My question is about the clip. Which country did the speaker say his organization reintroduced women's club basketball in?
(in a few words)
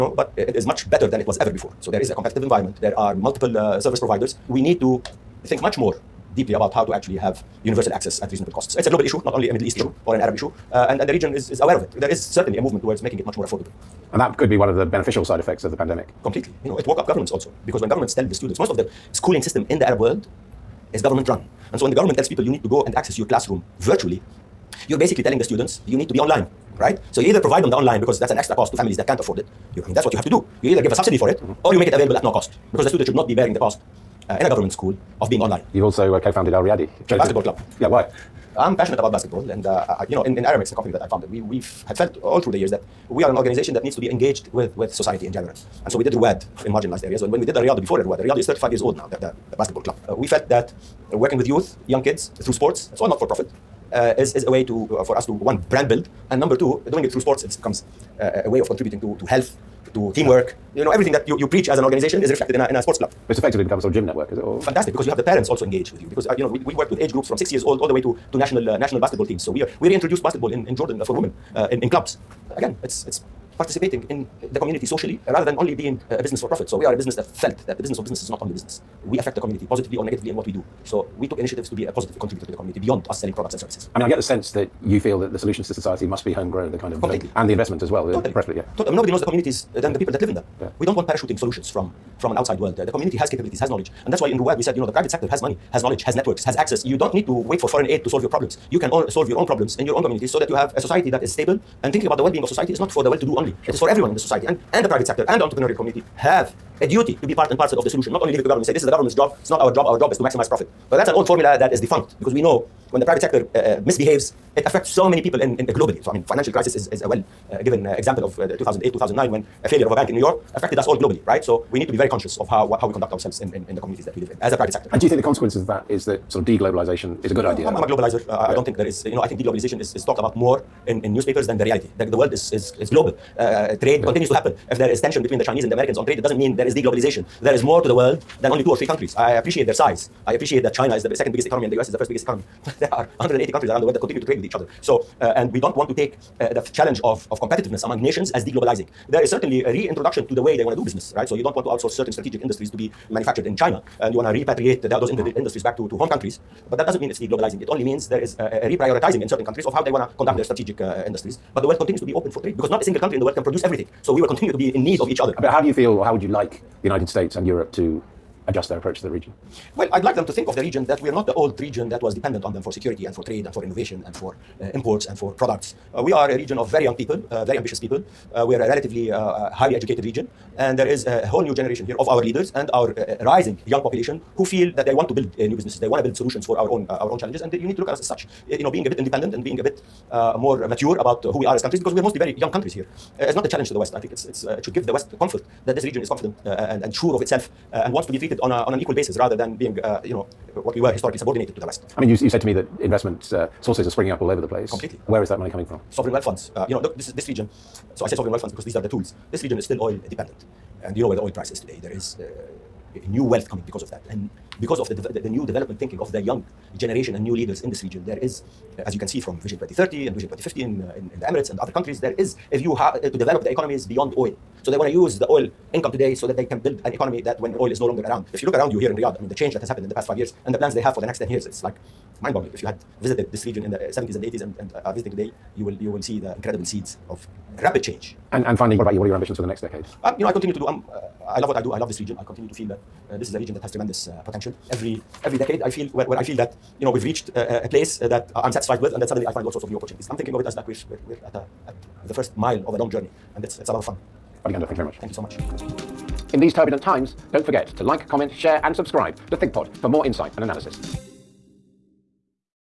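Jordan.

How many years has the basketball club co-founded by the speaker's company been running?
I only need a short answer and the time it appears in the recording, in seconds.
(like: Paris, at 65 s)
35, at 48 s.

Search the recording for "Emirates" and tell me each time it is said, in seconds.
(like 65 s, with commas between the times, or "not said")
221 s.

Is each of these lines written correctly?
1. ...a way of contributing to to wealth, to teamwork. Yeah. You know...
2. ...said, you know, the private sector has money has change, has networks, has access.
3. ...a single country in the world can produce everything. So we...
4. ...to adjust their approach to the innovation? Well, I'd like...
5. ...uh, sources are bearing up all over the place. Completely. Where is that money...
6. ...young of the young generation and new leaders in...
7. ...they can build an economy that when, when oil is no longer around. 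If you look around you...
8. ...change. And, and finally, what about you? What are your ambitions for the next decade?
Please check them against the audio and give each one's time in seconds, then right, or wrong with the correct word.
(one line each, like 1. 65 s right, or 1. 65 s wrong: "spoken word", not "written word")
1. 58 s wrong: "health", not "wealth"
2. 94 s wrong: "knowledge", not "change"
3. 162 s right
4. 167 s wrong: "region", not "innovation"
5. 203 s wrong: "springing", not "bearing"
6. 215 s wrong: "thinking", not "young"
7. 226 s right
8. 237 s right.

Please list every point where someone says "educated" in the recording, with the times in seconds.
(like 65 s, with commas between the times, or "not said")
179 s.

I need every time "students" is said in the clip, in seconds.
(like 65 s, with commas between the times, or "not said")
18 s, 25 s, 32 s.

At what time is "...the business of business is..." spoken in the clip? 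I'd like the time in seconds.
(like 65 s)
77 s.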